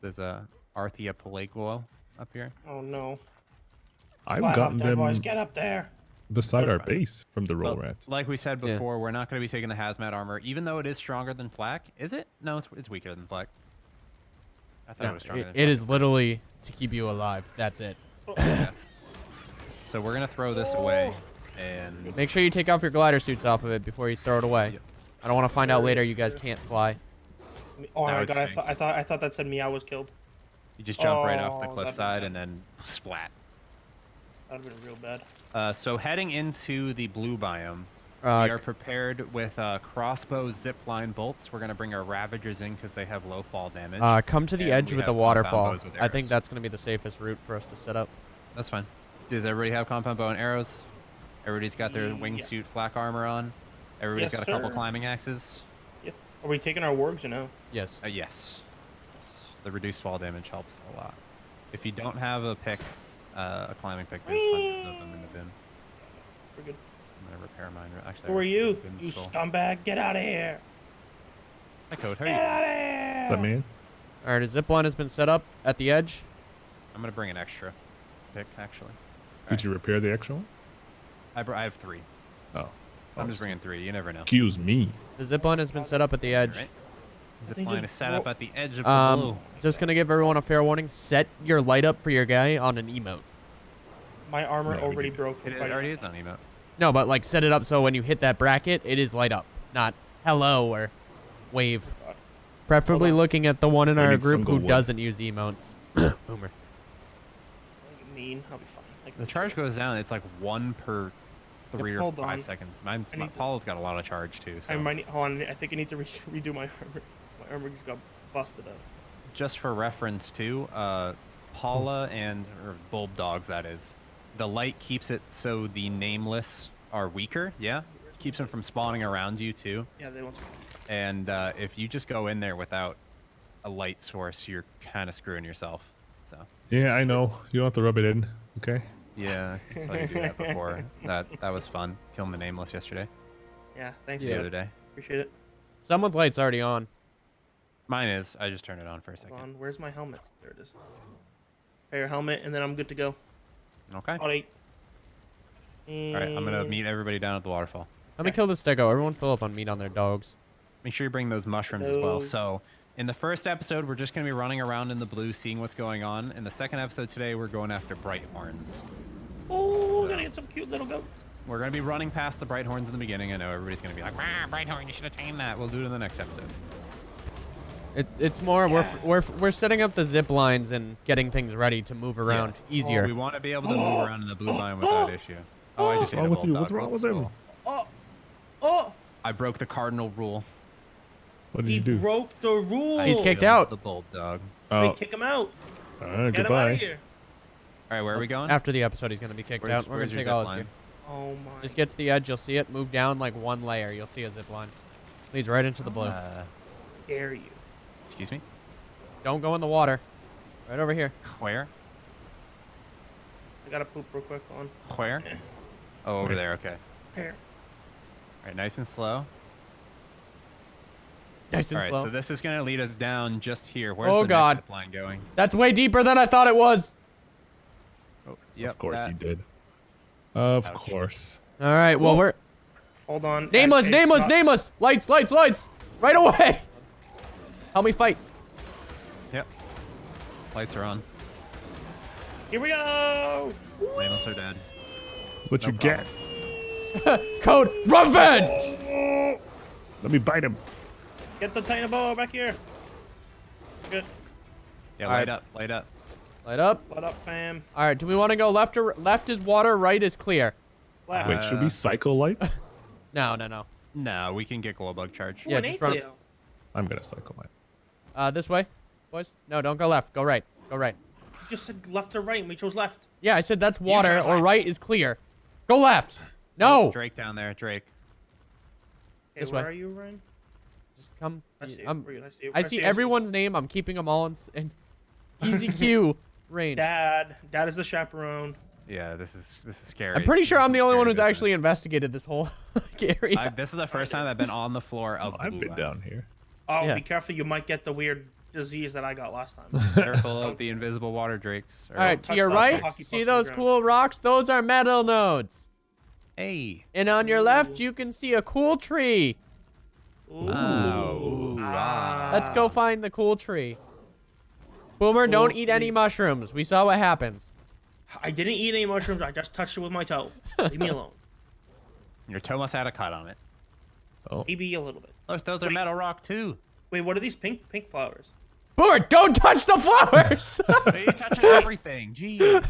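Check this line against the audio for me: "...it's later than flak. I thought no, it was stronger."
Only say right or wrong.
wrong.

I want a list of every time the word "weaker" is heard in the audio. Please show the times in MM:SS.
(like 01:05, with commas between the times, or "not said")
00:12, 02:07.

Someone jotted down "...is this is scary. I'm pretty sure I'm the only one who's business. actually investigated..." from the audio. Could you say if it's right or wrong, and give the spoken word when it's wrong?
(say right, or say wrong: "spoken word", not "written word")
right.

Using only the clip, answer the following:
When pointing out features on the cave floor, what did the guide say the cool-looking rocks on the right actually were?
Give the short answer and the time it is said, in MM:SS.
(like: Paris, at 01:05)
metal nodes, at 05:04.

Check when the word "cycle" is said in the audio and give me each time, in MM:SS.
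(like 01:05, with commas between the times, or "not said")
04:21, 04:27.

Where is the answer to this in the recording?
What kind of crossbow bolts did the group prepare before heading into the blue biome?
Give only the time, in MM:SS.
00:40.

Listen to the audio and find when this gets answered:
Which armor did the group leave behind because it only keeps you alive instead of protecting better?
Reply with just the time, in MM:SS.
00:09.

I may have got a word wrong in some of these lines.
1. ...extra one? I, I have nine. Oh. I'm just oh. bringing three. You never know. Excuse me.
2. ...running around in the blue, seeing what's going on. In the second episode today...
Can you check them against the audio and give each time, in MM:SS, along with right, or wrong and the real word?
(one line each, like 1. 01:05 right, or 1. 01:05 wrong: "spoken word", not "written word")
1. 01:20 wrong: "three", not "nine"
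2. 02:44 right.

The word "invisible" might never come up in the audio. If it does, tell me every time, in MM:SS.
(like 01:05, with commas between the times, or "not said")
05:00.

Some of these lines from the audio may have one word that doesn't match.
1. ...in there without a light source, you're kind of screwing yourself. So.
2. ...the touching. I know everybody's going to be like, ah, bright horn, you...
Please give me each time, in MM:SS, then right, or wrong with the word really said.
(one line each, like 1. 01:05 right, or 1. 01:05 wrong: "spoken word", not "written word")
1. 02:12 right
2. 02:52 wrong: "beginning", not "touching".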